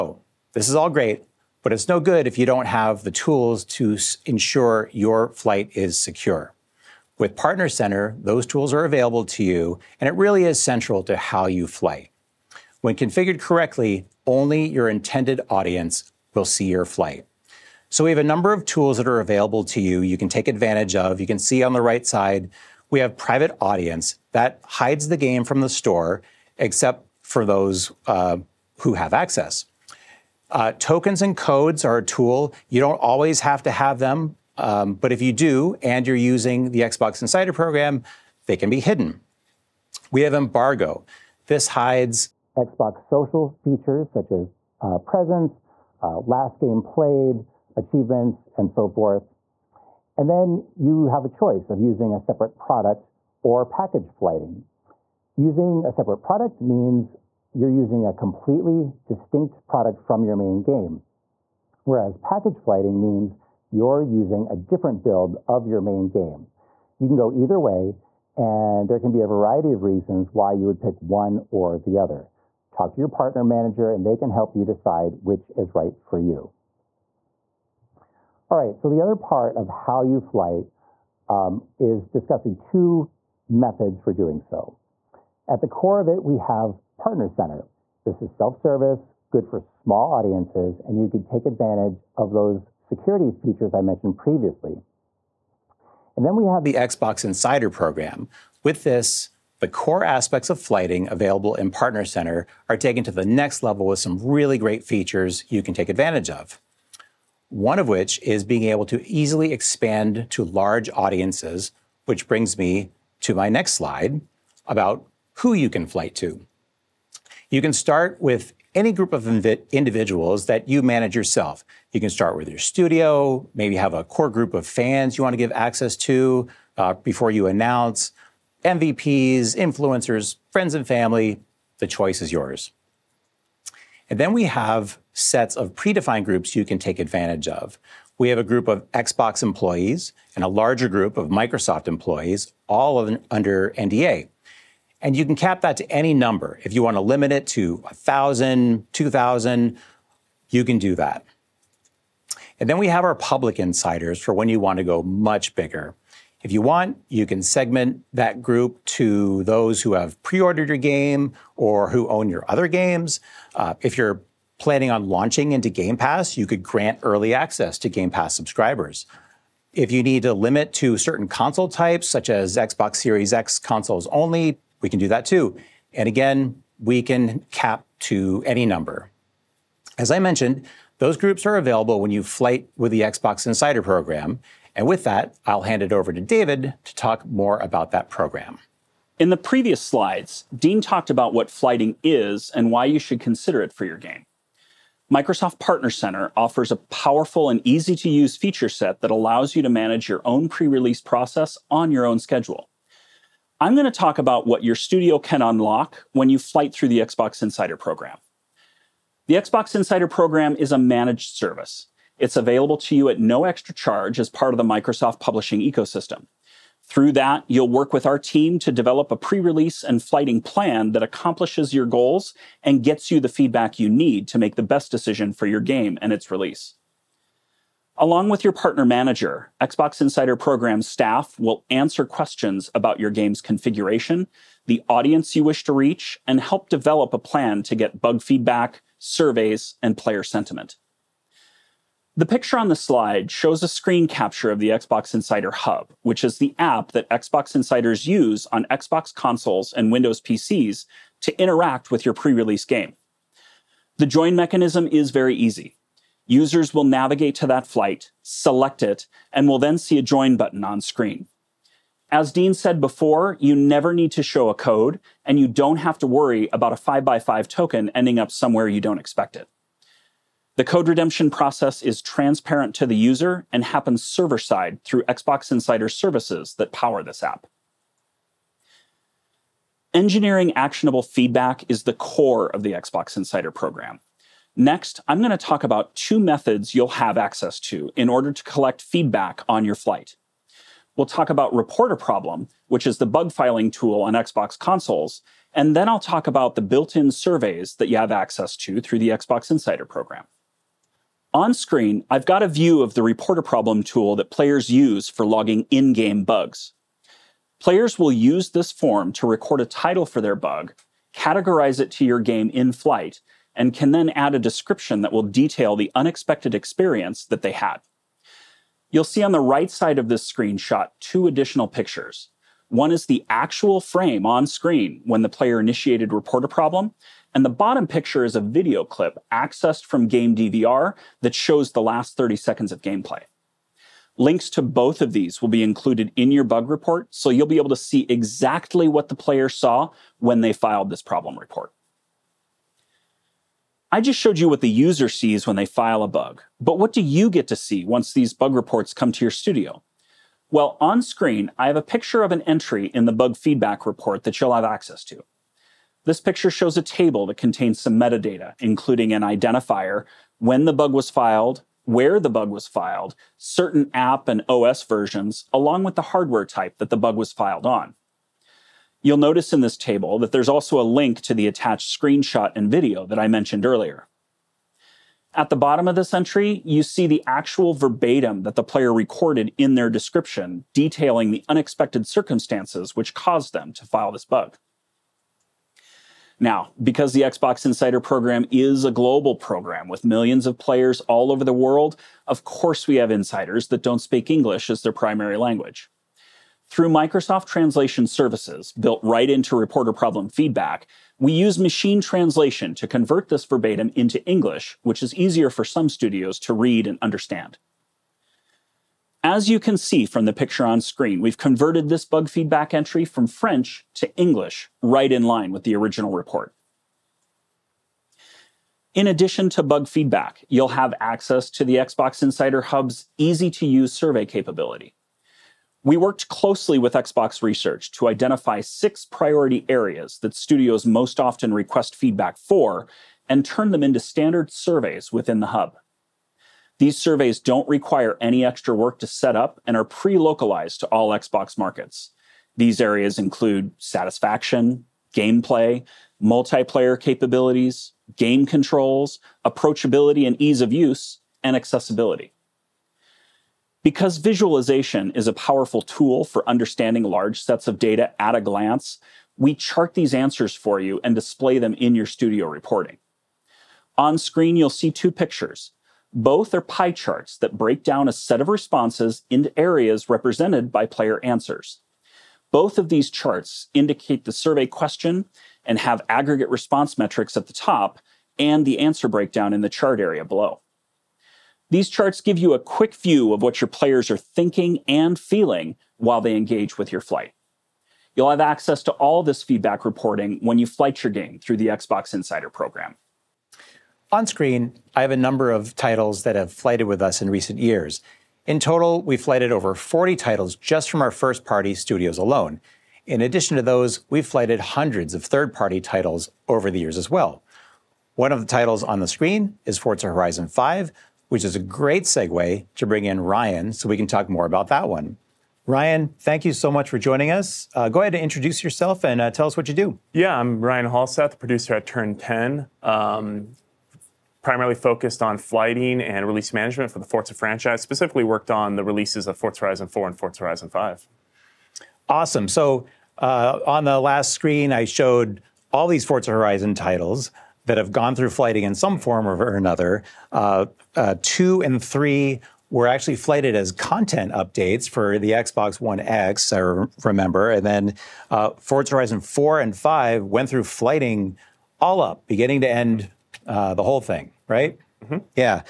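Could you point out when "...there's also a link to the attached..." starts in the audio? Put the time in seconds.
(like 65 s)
370 s.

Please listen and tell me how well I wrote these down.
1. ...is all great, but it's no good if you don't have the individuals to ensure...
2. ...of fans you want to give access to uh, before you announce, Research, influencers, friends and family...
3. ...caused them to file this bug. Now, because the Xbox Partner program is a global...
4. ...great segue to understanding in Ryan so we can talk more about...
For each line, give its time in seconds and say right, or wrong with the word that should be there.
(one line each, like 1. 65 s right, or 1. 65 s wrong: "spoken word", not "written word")
1. 0 s wrong: "tools", not "individuals"
2. 124 s wrong: "MVPs", not "Research"
3. 383 s wrong: "Insider", not "Partner"
4. 511 s wrong: "bring", not "understanding".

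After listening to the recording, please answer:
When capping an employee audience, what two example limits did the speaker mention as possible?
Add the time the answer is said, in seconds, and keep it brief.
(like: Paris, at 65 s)
1,000 or 2,000, at 147 s.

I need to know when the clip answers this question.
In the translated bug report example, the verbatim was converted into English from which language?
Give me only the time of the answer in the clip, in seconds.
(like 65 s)
413 s.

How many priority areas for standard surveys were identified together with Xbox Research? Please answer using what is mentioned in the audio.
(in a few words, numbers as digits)
6.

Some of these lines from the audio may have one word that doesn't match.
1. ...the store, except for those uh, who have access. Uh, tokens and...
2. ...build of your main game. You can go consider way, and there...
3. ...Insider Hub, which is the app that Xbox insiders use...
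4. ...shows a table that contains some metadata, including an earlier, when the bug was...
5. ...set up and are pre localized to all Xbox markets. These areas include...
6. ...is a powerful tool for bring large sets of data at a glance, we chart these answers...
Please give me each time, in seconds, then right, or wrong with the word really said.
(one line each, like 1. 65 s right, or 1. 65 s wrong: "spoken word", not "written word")
1. 25 s right
2. 65 s wrong: "either", not "consider"
3. 245 s right
4. 356 s wrong: "identifier", not "earlier"
5. 439 s right
6. 455 s wrong: "understanding", not "bring".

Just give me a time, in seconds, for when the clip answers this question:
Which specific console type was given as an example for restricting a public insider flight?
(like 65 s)
172 s.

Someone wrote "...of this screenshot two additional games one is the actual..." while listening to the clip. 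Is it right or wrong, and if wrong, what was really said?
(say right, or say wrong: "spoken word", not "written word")
wrong: "pictures", not "games".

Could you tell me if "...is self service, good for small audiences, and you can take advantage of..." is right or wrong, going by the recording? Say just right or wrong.
right.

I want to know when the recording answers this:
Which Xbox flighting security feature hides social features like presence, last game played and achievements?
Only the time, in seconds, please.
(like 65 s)
40 s.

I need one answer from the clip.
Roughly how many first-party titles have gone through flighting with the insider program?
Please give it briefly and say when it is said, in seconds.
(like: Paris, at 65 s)
Over 40, at 499 s.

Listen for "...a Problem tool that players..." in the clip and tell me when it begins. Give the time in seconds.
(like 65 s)
303 s.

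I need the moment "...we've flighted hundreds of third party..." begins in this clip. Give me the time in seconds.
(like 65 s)
504 s.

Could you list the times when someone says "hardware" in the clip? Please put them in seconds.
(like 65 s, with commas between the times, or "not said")
366 s.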